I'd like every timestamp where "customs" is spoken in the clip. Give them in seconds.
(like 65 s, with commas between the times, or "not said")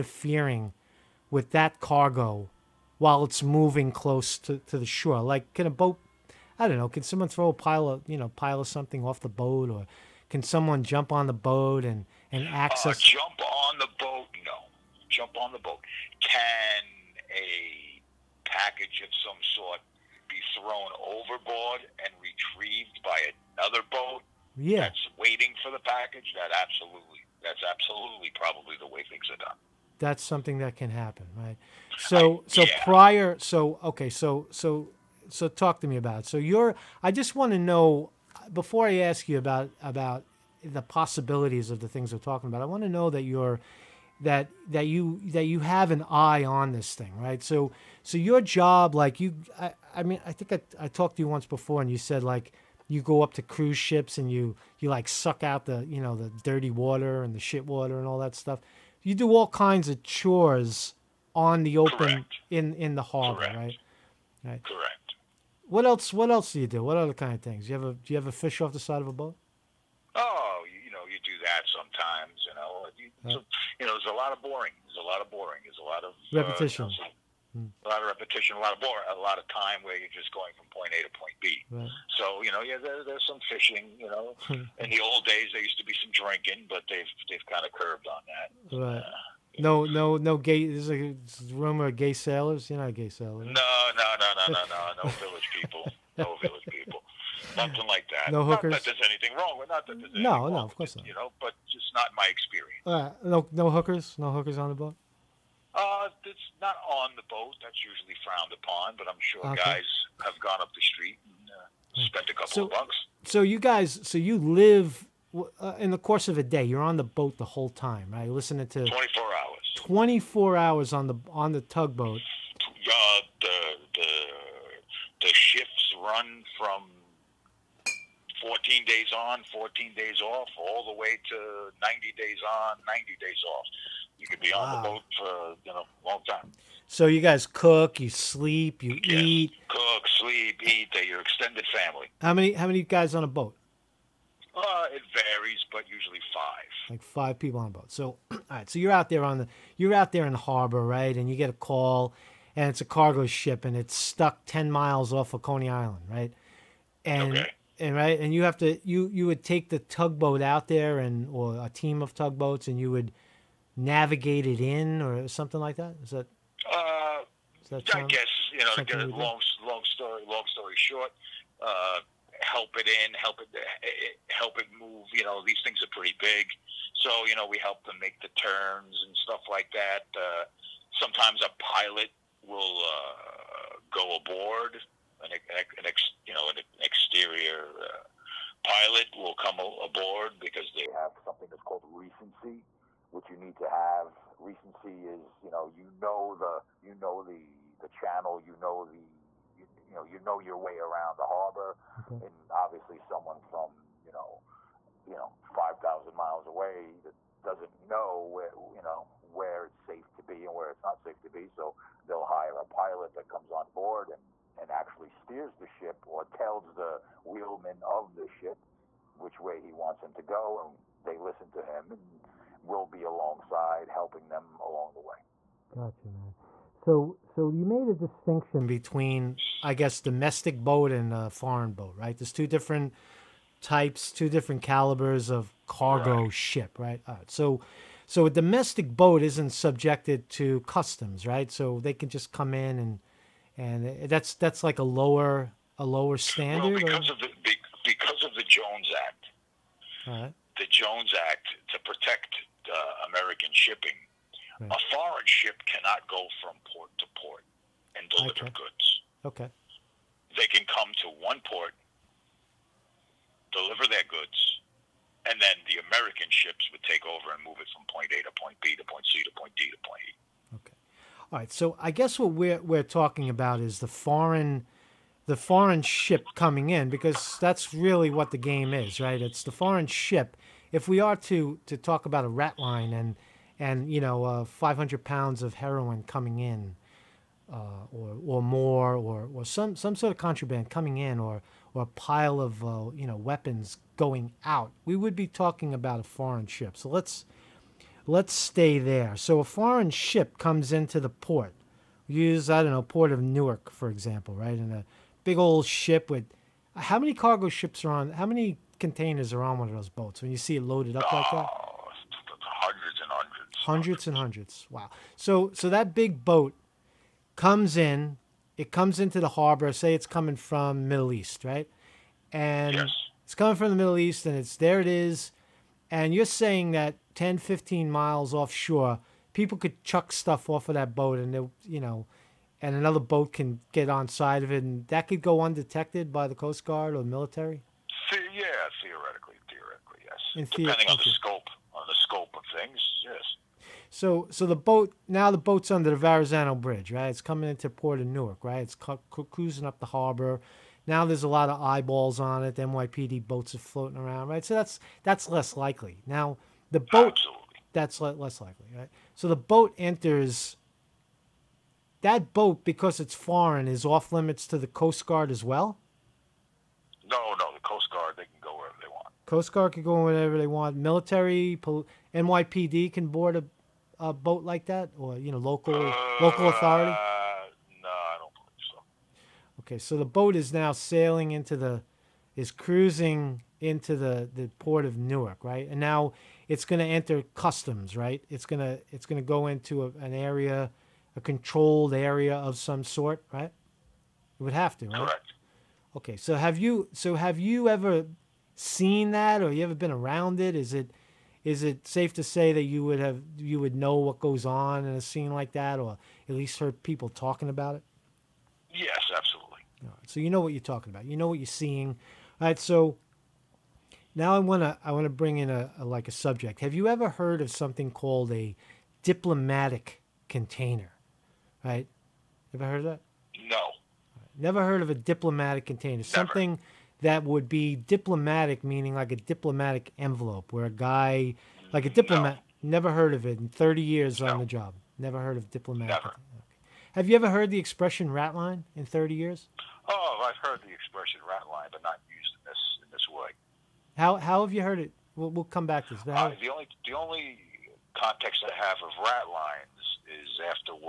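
240 s, 387 s.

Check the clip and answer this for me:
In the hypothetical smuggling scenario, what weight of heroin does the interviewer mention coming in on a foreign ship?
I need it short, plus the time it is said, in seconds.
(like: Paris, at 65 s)
500 pounds, at 284 s.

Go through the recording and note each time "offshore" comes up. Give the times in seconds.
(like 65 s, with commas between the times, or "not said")
328 s.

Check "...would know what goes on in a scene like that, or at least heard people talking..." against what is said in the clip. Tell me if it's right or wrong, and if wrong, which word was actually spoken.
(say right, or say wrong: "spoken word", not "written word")
right.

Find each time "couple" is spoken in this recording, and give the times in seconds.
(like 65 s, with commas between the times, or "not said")
112 s.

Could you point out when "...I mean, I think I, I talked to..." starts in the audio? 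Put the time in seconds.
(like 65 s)
49 s.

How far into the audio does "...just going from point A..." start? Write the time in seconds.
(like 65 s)
80 s.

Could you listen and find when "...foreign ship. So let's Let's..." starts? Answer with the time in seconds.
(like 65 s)
296 s.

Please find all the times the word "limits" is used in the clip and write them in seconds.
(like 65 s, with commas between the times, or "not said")
364 s.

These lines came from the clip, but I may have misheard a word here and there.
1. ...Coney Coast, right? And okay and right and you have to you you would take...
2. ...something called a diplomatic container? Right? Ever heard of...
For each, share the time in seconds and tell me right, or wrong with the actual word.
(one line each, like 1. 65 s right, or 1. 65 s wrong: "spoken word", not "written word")
1. 155 s wrong: "Island", not "Coast"
2. 417 s right.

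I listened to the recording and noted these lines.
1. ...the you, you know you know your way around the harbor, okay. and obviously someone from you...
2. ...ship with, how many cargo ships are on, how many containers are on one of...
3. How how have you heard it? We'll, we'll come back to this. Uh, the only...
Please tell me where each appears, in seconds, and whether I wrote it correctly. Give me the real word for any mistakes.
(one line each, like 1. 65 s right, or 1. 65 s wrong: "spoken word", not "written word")
1. 198 s right
2. 305 s right
3. 443 s right.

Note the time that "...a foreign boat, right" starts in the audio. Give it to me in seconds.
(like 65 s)
231 s.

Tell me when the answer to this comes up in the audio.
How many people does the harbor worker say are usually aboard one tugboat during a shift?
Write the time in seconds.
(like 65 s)
145 s.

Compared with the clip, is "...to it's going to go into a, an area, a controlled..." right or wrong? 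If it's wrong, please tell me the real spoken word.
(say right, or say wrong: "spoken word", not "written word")
right.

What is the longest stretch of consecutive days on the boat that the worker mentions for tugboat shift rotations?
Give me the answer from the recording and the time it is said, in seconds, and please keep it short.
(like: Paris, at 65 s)
90 days, at 131 s.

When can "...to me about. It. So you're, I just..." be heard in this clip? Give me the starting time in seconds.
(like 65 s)
35 s.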